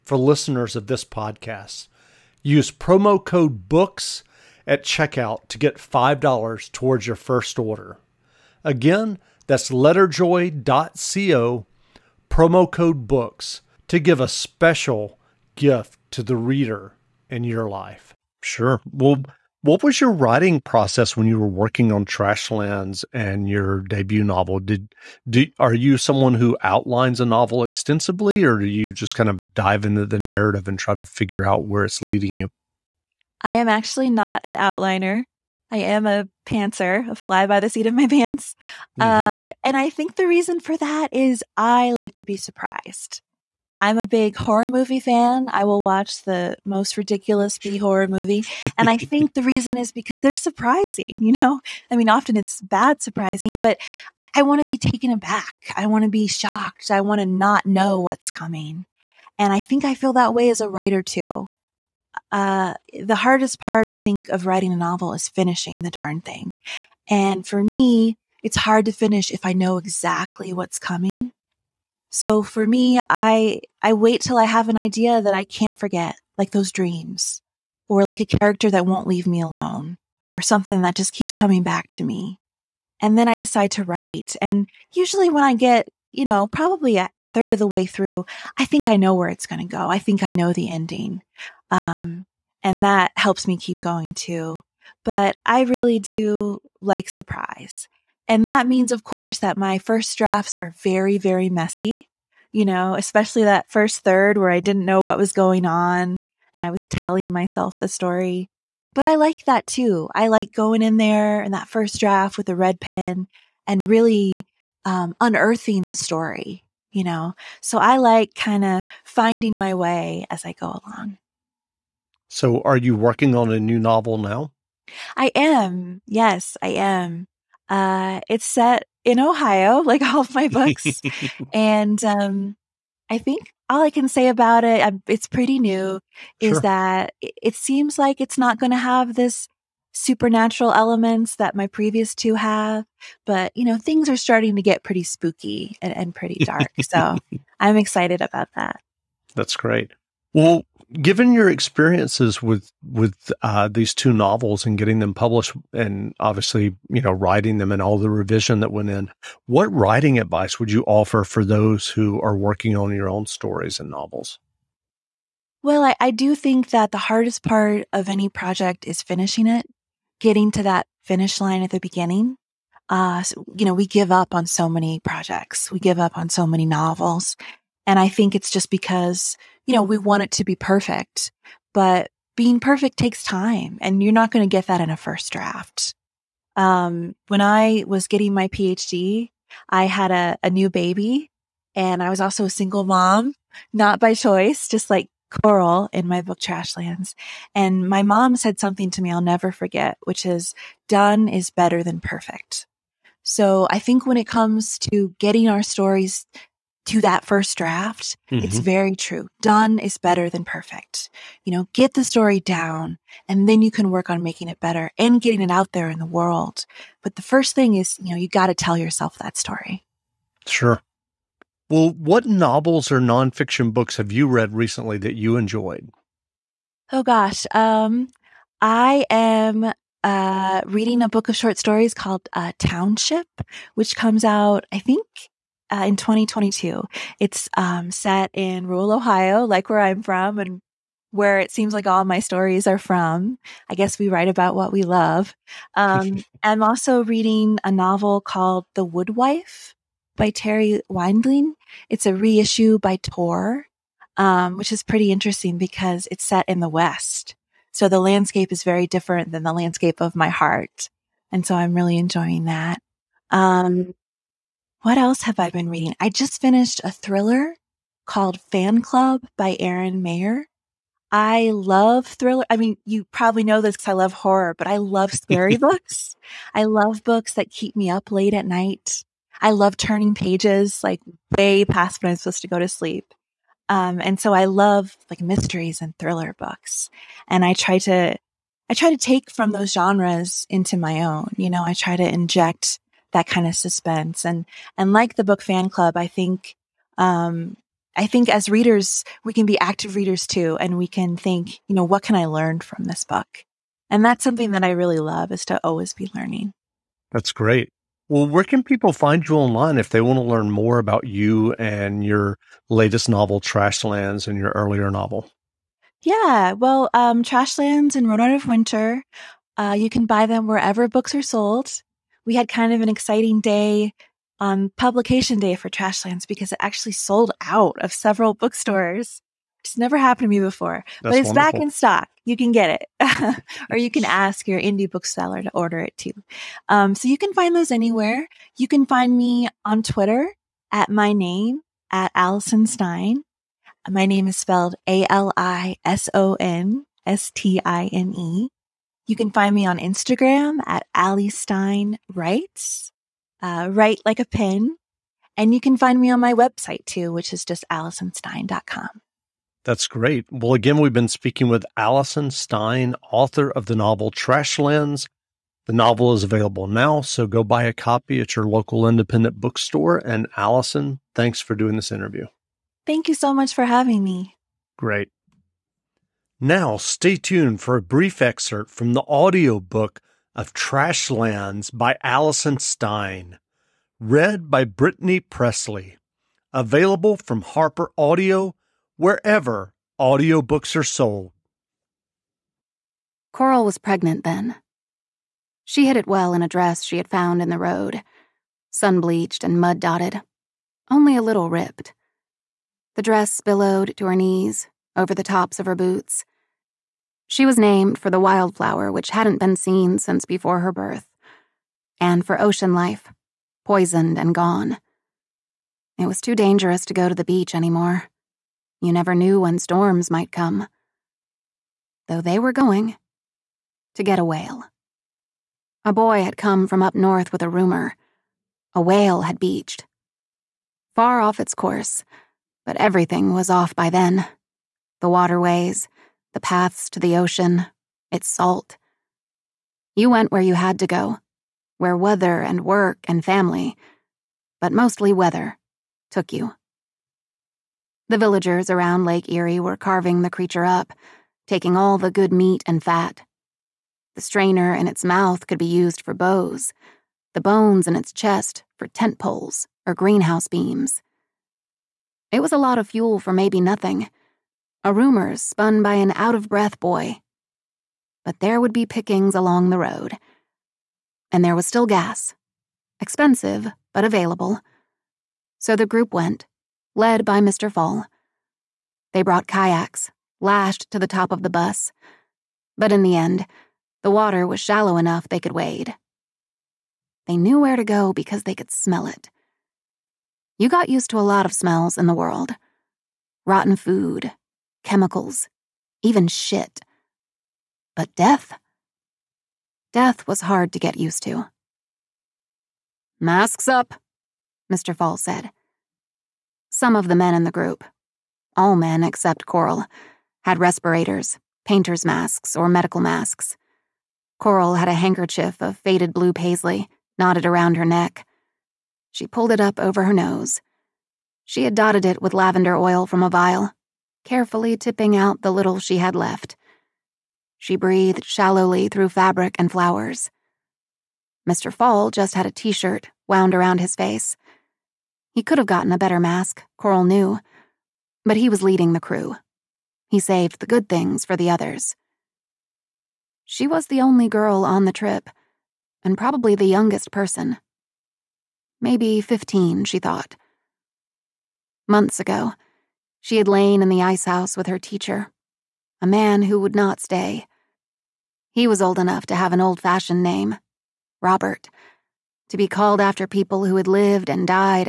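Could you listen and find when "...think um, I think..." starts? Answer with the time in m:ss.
4:56.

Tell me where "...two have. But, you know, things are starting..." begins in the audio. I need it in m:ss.
2:22.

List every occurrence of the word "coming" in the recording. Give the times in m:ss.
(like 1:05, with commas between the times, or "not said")
0:58, 1:10, 1:21.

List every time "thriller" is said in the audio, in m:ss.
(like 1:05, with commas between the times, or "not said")
4:26, 4:32, 4:45.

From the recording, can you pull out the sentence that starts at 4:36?
I love books that keep me up late at night.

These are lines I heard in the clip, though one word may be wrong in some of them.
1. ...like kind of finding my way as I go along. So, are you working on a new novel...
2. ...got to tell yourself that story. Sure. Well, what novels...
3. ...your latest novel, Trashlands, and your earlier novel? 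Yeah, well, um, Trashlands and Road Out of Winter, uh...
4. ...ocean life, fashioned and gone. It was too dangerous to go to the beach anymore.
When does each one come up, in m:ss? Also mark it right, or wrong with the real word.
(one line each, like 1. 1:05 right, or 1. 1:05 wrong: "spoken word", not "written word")
1. 1:57 right
2. 3:38 right
3. 5:12 right
4. 6:52 wrong: "poisoned", not "fashioned".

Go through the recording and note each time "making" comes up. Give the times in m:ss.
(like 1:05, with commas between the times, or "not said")
3:34.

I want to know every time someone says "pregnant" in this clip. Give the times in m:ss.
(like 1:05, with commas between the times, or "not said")
6:33.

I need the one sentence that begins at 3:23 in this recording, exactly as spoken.
So I think when it comes to getting our stories to that first draft.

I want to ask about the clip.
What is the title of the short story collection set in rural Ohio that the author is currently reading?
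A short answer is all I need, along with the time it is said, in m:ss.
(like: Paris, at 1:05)
Township, at 3:52.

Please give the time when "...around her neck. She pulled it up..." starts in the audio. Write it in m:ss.
8:37.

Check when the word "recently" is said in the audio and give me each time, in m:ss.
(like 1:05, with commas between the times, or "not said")
3:44.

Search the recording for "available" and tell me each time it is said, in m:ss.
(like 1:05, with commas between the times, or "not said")
6:06, 6:26, 7:54.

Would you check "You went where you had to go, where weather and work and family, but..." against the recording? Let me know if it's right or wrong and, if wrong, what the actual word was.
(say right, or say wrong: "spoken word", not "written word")
right.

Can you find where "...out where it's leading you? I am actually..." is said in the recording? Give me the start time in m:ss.
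0:31.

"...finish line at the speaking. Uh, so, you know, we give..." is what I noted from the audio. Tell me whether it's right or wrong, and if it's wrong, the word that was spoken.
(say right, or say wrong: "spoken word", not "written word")
wrong: "beginning", not "speaking".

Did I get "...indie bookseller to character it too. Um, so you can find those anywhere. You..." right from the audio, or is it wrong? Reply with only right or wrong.
wrong.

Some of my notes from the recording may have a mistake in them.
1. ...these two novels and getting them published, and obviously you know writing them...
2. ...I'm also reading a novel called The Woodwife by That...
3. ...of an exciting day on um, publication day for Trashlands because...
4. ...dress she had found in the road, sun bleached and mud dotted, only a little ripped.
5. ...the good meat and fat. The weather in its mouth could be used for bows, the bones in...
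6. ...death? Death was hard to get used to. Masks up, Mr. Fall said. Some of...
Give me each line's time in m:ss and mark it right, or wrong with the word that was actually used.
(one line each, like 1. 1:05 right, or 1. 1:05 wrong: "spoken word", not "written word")
1. 2:33 right
2. 4:06 wrong: "Terri", not "That"
3. 5:22 right
4. 6:36 right
5. 7:31 wrong: "strainer", not "weather"
6. 8:18 right.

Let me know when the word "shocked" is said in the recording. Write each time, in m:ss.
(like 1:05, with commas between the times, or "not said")
0:56.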